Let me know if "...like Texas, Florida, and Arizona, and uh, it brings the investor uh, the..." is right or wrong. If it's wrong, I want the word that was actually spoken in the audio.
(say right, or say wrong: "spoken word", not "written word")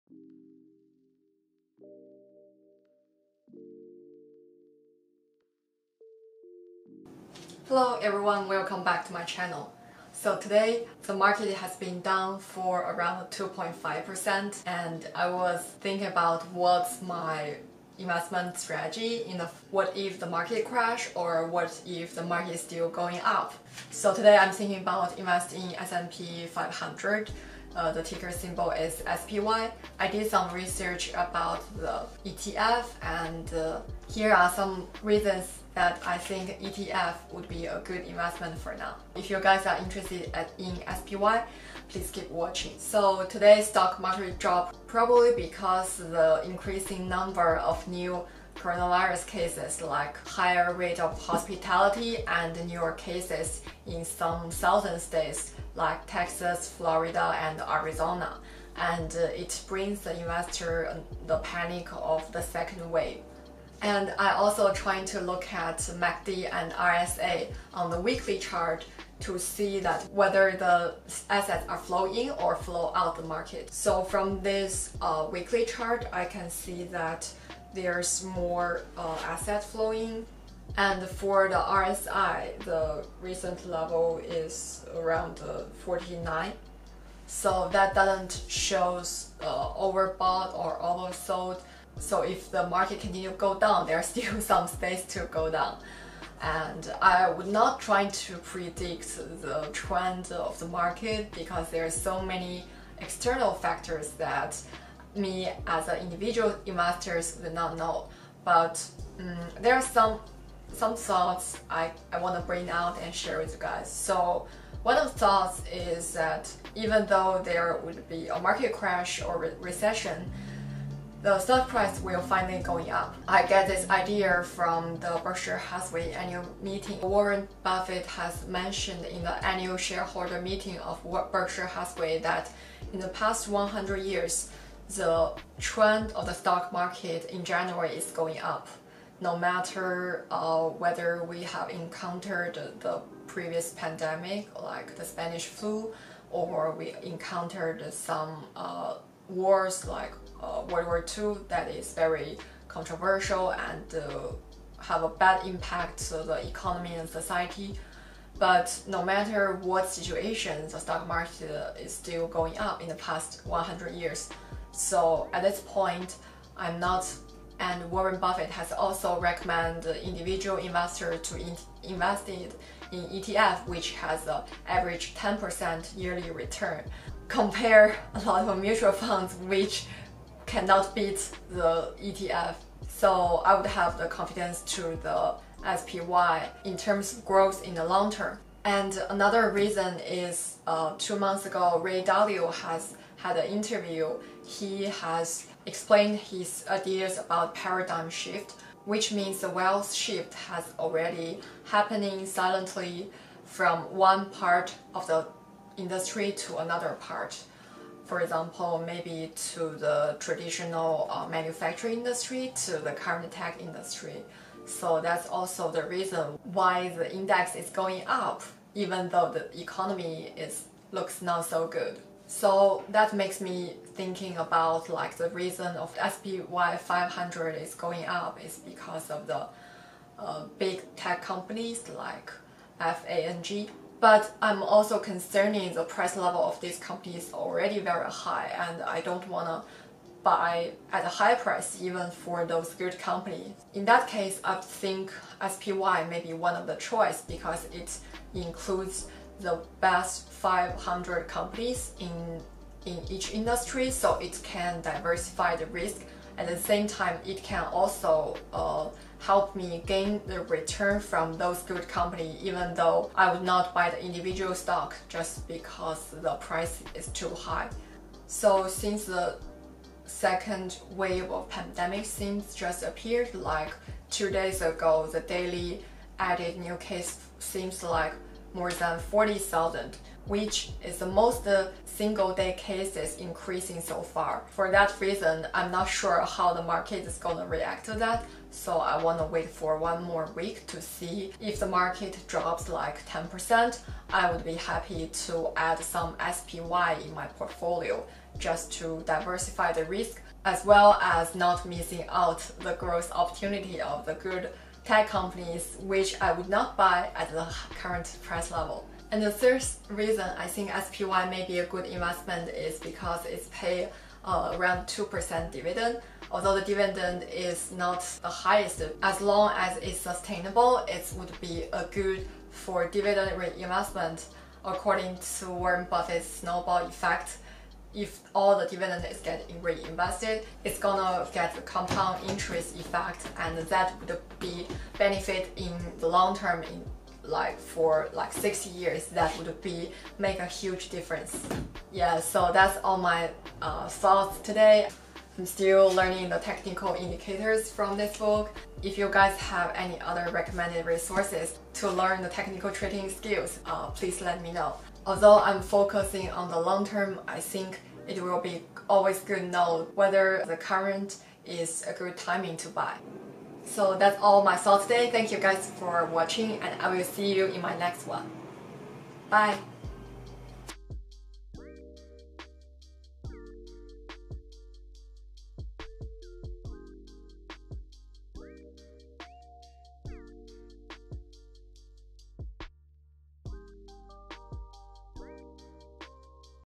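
right.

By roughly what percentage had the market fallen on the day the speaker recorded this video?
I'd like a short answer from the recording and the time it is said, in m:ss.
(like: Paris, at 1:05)
2.5%, at 0:13.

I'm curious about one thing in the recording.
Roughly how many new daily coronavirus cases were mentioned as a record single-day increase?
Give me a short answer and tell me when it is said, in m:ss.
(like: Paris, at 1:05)
40,000, at 4:38.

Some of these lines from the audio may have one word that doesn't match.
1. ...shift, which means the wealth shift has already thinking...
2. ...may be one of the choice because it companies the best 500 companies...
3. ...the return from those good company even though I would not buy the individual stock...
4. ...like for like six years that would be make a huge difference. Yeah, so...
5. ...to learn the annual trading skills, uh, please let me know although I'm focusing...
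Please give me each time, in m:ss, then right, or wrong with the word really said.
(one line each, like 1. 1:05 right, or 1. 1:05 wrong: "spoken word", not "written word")
1. 3:18 wrong: "happening", not "thinking"
2. 4:06 wrong: "includes", not "companies"
3. 4:20 right
4. 5:37 right
5. 5:51 wrong: "technical", not "annual".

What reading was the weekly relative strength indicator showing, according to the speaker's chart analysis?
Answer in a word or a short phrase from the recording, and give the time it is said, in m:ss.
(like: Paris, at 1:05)
49, at 1:25.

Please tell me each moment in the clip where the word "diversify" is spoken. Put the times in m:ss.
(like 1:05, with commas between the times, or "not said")
4:14, 4:59.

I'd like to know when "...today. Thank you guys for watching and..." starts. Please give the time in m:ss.
6:04.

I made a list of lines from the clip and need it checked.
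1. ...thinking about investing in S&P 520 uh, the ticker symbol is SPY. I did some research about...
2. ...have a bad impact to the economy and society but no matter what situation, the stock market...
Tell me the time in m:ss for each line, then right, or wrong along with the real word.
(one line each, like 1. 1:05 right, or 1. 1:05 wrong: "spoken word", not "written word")
1. 0:24 wrong: "500", not "520"
2. 2:34 right.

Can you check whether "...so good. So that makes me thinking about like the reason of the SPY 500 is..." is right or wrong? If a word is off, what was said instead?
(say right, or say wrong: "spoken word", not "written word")
right.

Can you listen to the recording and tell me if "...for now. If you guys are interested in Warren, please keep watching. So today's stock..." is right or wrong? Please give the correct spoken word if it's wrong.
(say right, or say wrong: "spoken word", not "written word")
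wrong: "SPY", not "Warren".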